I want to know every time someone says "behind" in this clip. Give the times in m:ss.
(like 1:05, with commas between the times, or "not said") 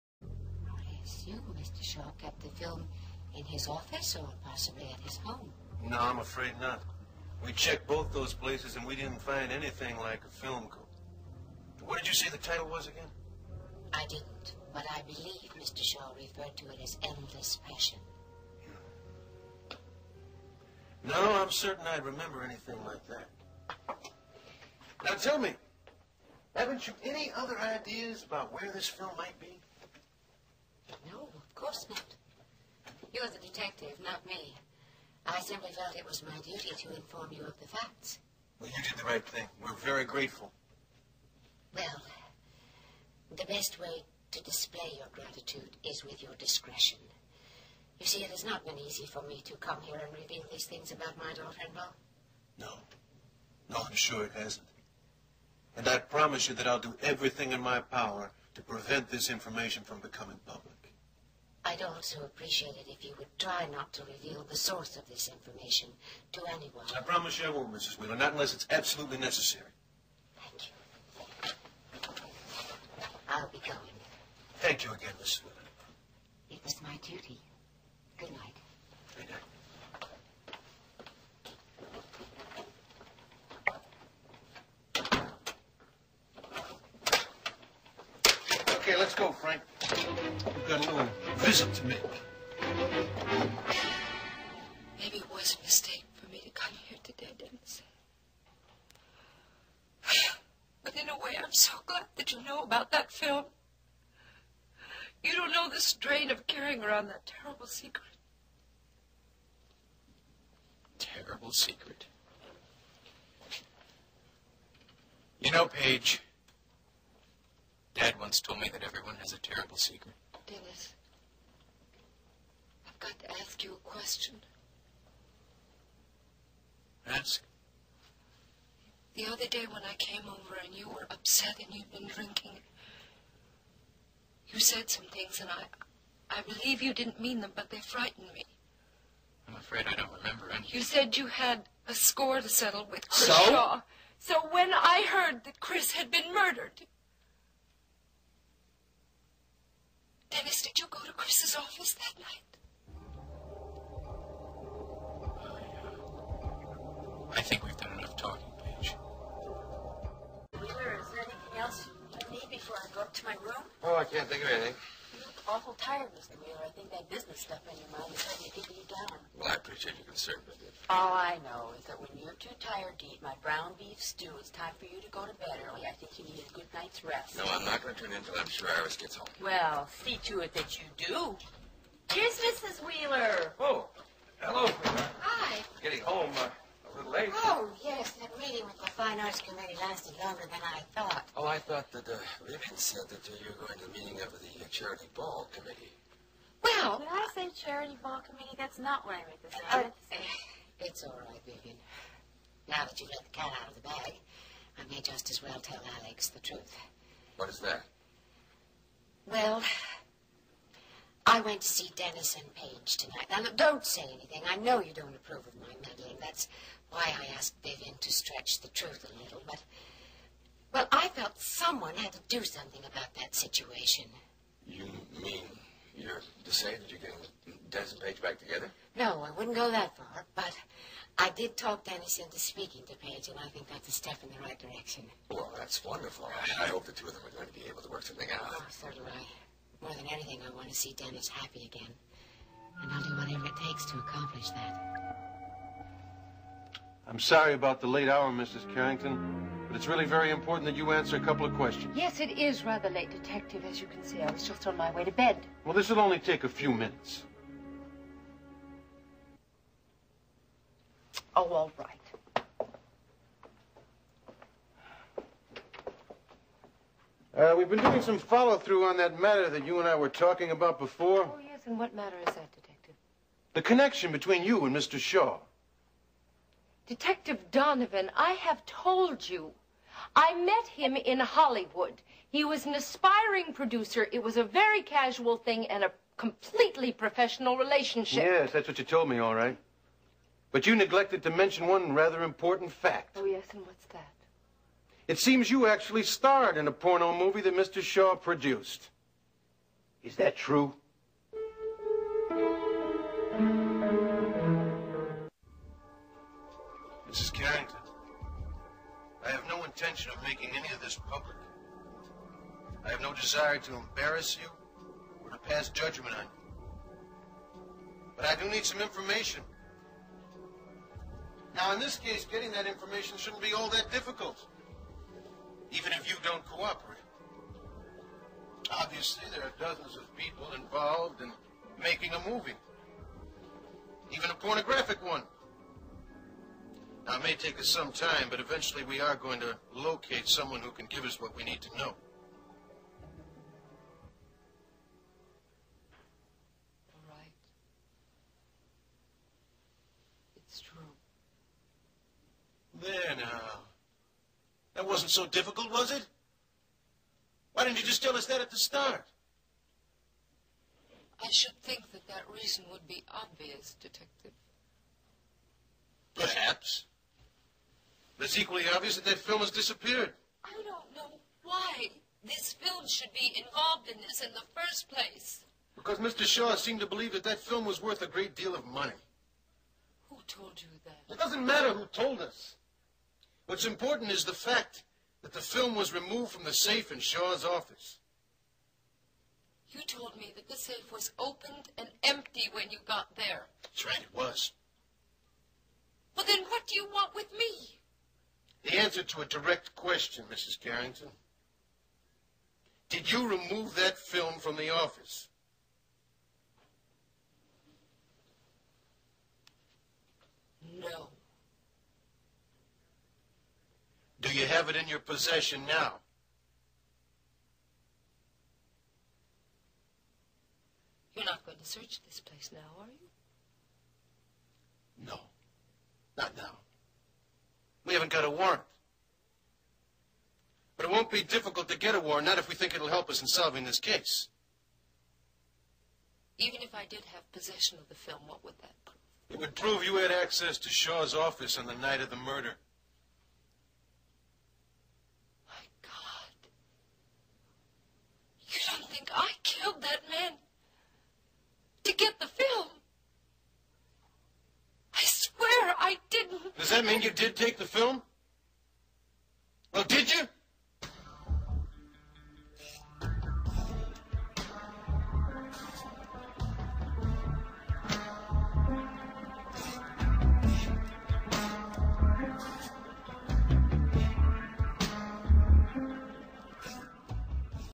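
not said.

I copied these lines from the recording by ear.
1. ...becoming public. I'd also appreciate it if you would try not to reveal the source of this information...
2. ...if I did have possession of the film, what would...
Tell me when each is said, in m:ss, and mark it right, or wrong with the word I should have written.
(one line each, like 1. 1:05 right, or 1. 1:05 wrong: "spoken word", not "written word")
1. 0:59 right
2. 7:16 right.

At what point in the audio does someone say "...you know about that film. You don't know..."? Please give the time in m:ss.
1:42.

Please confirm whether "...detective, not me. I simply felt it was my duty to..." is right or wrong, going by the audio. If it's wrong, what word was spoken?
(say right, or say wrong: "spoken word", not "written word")
right.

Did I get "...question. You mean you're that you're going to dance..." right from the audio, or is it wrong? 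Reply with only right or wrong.
wrong.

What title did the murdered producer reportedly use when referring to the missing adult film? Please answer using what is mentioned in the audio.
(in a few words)
Endless Passion.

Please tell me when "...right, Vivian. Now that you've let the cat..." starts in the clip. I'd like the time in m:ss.
3:21.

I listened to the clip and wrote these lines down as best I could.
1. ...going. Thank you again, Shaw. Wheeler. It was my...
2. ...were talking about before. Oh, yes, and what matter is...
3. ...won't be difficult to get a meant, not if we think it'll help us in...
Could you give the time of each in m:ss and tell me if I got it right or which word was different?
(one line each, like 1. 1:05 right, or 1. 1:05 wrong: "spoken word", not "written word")
1. 1:13 wrong: "Mrs", not "Shaw"
2. 4:29 right
3. 7:10 wrong: "warrant", not "meant".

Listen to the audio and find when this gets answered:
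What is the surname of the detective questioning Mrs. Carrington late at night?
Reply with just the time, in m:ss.
4:37.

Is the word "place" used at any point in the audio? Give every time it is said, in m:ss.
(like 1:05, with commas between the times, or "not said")
0:08, 6:14, 7:02.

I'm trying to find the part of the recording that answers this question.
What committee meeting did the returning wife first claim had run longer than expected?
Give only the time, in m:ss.
3:08.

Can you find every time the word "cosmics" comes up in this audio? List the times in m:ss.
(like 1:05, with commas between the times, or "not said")
not said.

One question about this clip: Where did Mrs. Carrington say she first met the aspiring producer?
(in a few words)
Hollywood.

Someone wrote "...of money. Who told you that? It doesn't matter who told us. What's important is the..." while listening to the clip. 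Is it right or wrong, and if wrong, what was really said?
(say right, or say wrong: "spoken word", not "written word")
right.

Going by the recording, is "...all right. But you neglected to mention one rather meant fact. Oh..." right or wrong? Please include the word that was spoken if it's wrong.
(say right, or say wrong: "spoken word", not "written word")
wrong: "important", not "meant".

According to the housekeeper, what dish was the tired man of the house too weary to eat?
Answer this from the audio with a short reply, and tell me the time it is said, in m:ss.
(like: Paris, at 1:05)
brown beef stew, at 2:53.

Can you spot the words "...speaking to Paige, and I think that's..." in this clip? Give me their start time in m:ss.
3:52.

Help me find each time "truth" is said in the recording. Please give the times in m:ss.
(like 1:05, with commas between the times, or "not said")
3:26, 3:38.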